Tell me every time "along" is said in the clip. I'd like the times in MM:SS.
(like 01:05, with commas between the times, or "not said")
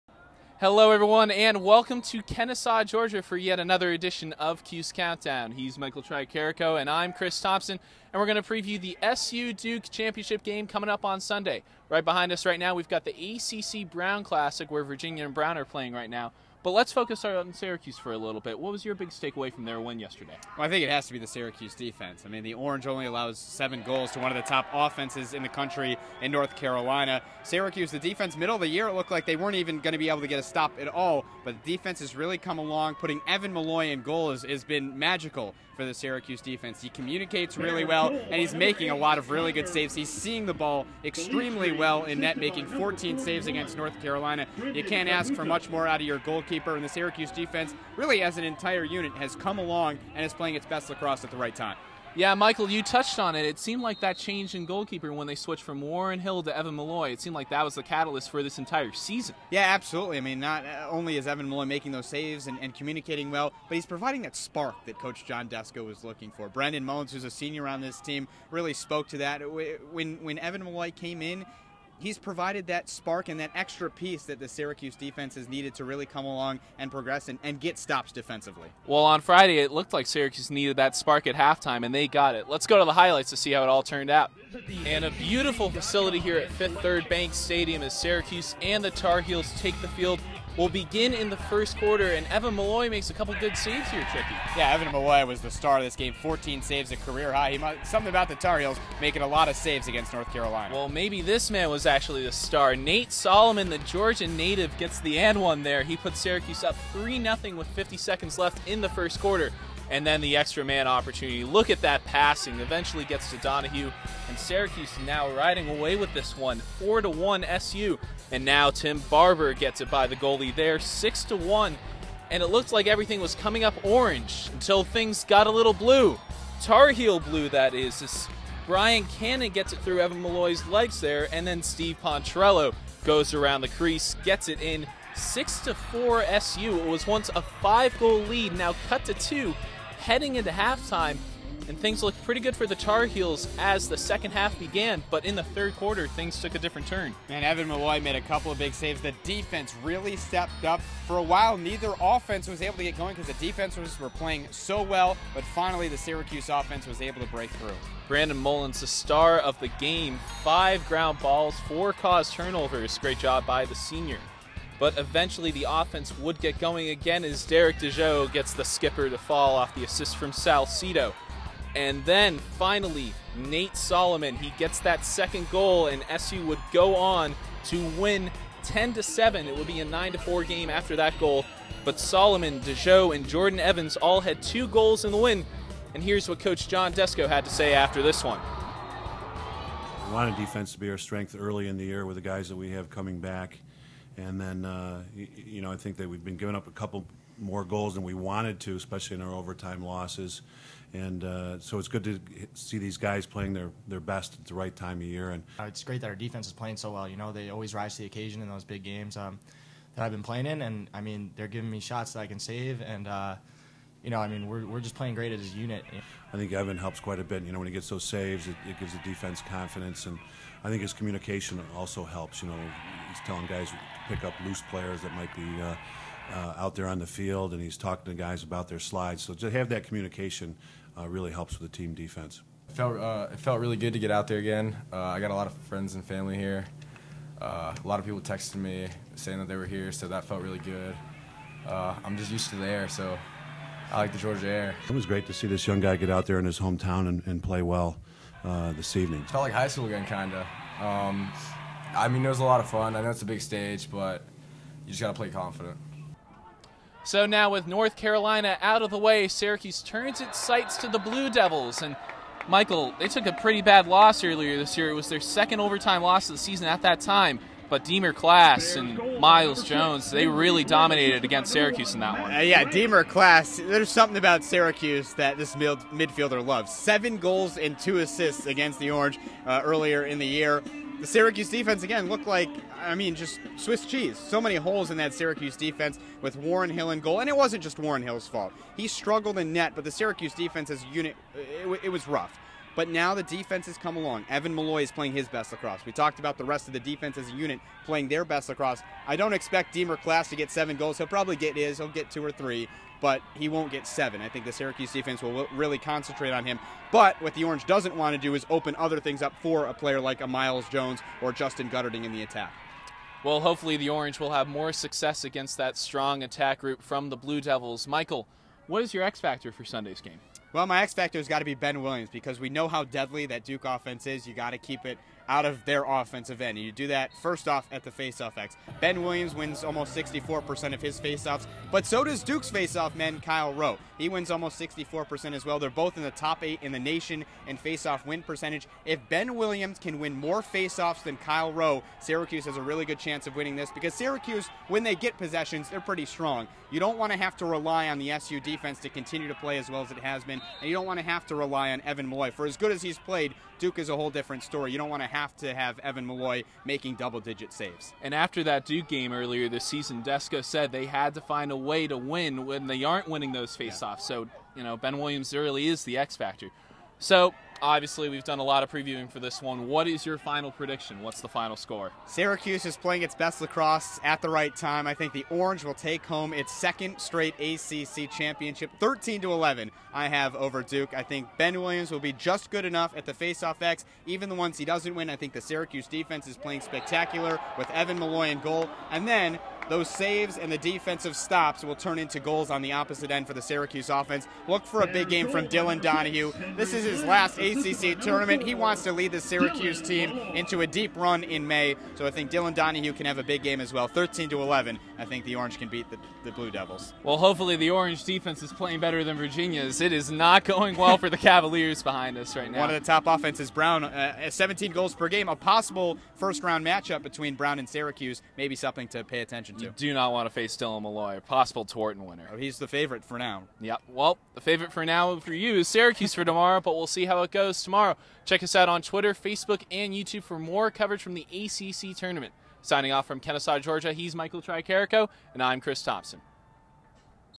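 00:32, 00:49, 01:16, 04:53.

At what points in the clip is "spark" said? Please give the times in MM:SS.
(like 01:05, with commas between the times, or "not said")
01:04, 01:12, 01:20.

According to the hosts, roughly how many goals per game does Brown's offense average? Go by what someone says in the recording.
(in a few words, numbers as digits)
17.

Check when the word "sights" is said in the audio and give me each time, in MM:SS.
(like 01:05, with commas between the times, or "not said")
04:20.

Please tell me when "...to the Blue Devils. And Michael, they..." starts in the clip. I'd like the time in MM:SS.
04:20.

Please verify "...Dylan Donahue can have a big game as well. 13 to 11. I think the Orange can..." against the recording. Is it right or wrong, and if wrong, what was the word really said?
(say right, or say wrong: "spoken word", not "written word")
right.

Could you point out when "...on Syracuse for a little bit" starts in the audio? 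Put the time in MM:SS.
00:17.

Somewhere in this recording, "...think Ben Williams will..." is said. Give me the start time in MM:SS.
06:21.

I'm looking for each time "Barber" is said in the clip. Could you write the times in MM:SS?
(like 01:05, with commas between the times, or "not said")
01:59.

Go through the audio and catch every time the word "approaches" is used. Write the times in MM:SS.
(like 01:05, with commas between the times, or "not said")
not said.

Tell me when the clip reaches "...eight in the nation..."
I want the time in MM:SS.
05:36.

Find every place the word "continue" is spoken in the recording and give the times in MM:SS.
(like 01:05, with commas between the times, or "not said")
05:48.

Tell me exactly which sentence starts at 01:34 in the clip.
Yeah, Evan Molloy was the star of this game.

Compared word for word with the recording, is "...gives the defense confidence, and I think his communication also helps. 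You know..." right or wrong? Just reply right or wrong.
right.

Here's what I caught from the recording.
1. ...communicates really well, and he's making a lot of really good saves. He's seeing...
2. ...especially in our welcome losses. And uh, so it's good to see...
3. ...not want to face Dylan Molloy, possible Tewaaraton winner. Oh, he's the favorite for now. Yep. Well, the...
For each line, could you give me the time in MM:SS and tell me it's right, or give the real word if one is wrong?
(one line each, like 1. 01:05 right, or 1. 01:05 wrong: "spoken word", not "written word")
1. 00:36 right
2. 03:18 wrong: "overtime", not "welcome"
3. 06:59 right.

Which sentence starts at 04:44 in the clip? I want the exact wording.
So many holes in that Syracuse defense with Warren Hill in goal, and it wasn't just Warren Hill's fault.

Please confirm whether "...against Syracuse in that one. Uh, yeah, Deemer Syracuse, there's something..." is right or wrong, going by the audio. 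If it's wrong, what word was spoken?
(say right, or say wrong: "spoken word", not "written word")
wrong: "Class", not "Syracuse".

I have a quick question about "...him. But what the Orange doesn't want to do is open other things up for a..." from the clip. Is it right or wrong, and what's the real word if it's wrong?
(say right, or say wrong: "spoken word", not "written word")
right.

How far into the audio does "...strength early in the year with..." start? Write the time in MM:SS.
03:10.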